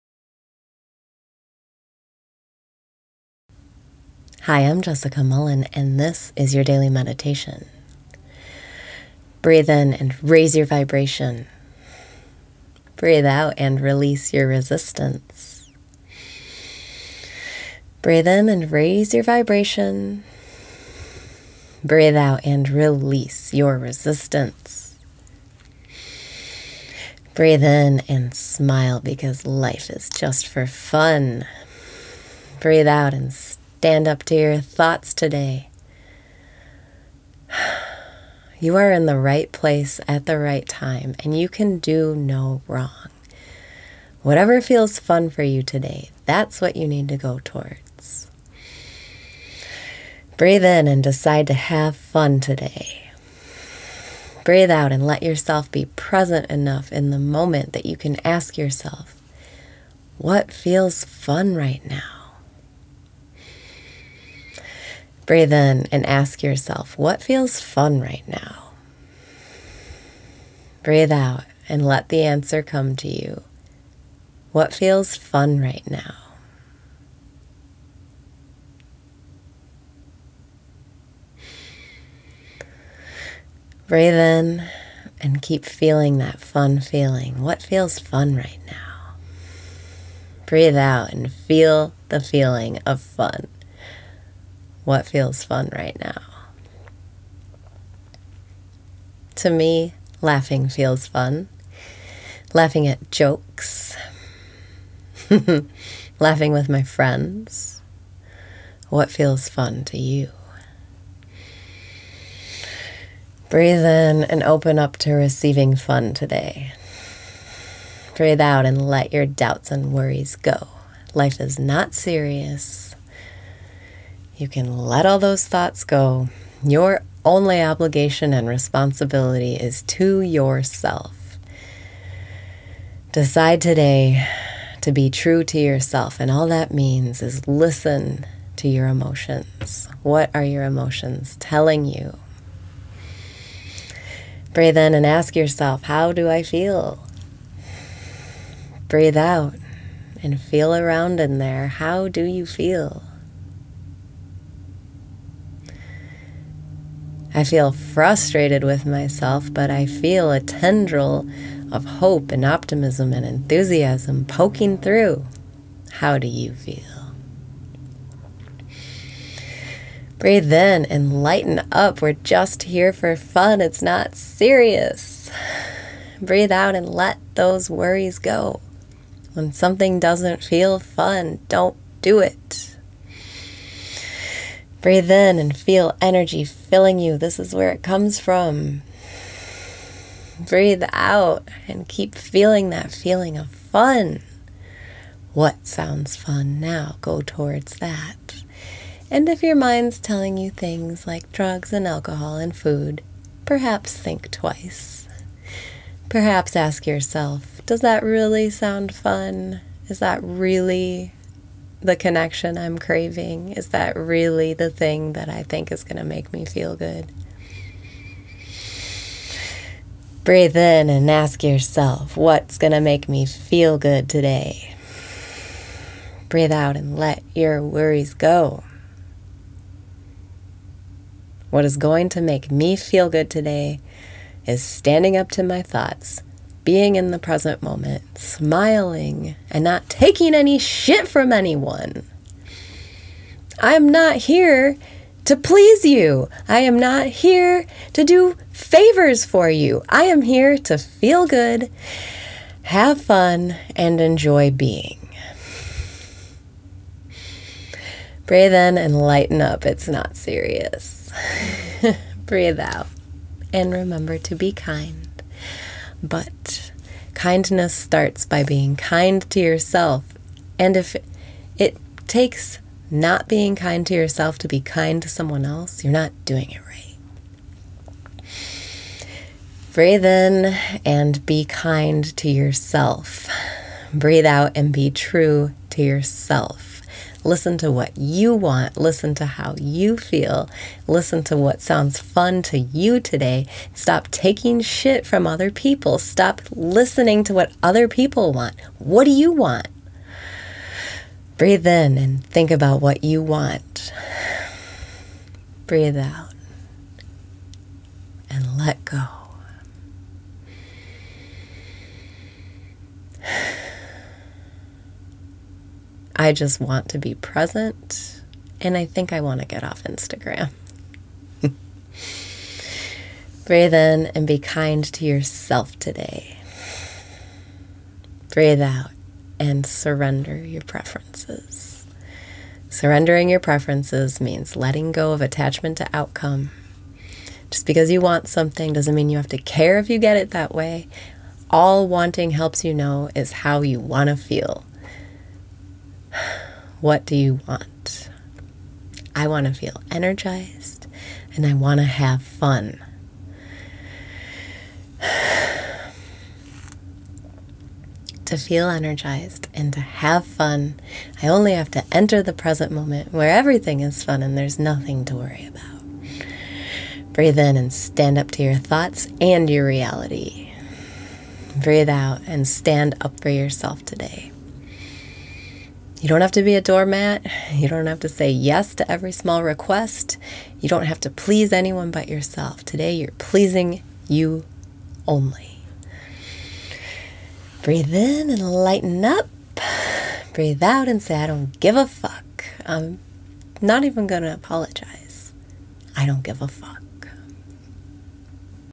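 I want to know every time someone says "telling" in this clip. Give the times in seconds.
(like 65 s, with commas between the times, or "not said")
141 s, 199 s.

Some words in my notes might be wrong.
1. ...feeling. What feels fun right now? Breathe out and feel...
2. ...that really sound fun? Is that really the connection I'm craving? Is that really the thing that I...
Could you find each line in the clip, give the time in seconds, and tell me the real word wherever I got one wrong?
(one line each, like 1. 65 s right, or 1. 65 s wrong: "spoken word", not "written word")
1. 86 s right
2. 207 s right.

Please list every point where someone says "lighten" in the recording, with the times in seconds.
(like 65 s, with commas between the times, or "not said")
171 s, 258 s, 388 s.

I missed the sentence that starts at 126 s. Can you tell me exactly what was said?
Your only obligation and responsibility is to yourself.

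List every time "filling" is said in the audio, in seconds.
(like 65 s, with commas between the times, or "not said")
186 s.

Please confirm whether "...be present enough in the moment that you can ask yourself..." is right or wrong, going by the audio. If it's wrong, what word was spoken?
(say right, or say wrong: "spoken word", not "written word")
right.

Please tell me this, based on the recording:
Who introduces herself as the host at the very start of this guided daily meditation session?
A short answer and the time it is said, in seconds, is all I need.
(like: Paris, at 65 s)
Jessica Mullen, at 4 s.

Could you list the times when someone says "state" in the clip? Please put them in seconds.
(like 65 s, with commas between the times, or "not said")
not said.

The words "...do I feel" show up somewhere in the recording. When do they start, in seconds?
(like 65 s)
146 s.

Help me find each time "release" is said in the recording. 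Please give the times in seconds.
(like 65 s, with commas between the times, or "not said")
13 s, 22 s.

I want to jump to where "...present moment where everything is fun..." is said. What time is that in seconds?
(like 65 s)
362 s.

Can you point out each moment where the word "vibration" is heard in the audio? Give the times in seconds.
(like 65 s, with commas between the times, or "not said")
10 s, 19 s.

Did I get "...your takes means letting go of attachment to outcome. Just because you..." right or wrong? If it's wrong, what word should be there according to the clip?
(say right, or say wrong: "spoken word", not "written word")
wrong: "preferences", not "takes".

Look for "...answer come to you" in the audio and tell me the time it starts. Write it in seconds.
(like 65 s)
72 s.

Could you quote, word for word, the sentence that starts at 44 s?
Whatever feels fun for you today, that's what you need to go towards.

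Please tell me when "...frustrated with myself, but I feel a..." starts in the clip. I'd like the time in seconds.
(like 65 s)
157 s.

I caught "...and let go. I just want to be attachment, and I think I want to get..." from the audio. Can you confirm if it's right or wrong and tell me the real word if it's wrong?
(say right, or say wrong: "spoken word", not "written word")
wrong: "present", not "attachment".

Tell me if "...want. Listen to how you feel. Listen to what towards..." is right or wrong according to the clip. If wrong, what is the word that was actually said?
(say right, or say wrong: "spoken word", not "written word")
wrong: "sounds", not "towards".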